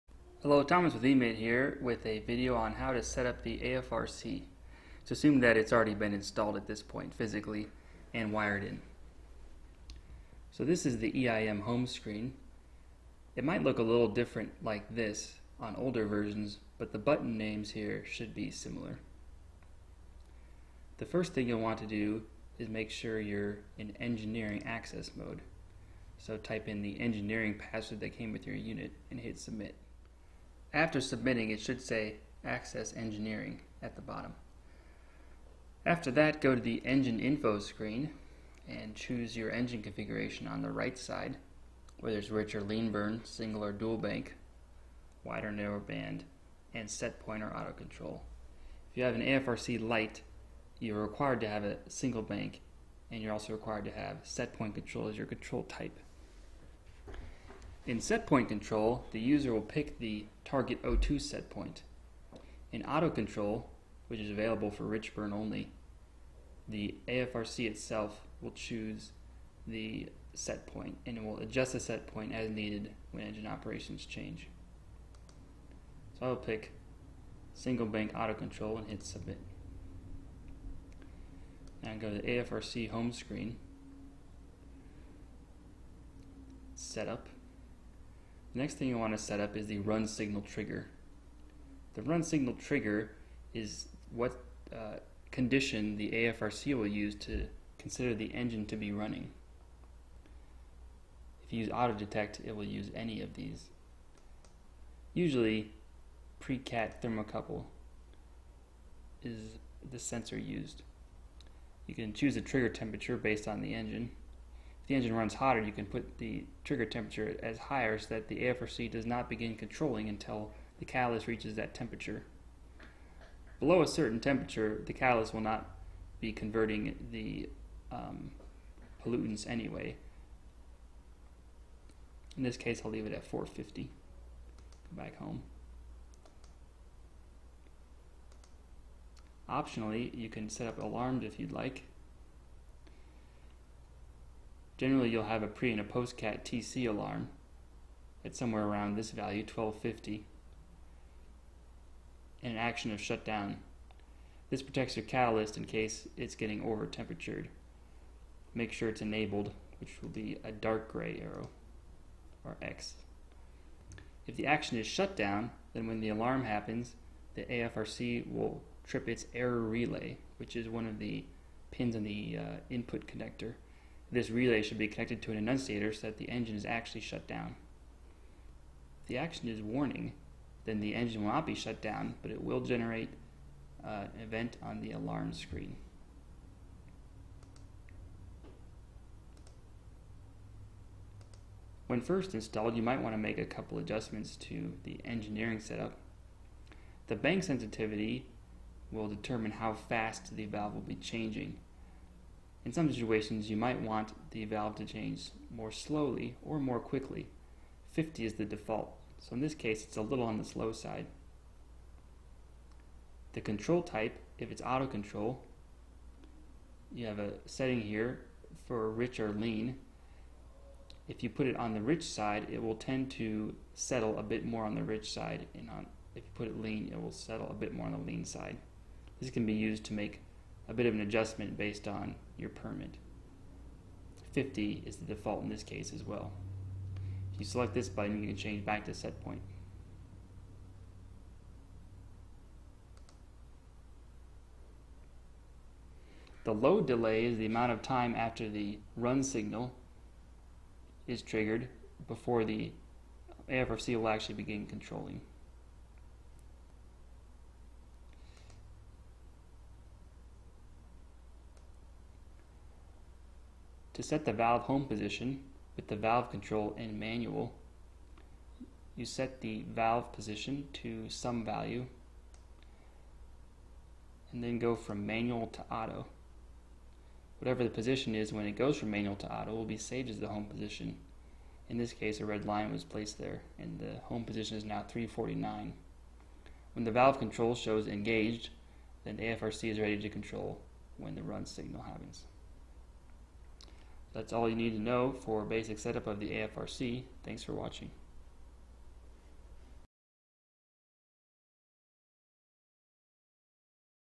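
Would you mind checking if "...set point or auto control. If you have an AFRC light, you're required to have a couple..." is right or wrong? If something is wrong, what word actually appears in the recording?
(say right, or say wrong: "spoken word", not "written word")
wrong: "single", not "couple".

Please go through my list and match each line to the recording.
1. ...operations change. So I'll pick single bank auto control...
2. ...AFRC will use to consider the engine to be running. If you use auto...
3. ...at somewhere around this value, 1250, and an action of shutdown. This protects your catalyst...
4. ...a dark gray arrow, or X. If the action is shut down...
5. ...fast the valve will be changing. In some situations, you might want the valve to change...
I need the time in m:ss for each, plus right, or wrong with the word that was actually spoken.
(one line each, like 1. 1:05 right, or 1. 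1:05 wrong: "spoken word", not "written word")
1. 1:13 right
2. 1:36 right
3. 2:28 right
4. 2:40 right
5. 3:19 right.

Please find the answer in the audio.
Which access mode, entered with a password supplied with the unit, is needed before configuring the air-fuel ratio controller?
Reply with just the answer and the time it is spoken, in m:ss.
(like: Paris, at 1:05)
Engineering access mode, at 0:23.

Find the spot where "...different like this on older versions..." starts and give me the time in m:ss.
0:14.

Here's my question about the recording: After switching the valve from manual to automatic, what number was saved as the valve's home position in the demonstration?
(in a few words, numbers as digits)
349.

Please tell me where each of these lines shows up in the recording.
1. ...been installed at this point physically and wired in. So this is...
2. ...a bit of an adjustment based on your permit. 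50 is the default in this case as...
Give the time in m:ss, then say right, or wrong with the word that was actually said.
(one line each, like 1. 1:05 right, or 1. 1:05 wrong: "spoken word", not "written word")
1. 0:05 right
2. 3:50 right.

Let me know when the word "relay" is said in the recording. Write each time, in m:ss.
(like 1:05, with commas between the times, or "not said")
2:49, 2:54.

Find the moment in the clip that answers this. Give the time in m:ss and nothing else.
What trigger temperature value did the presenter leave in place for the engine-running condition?
2:13.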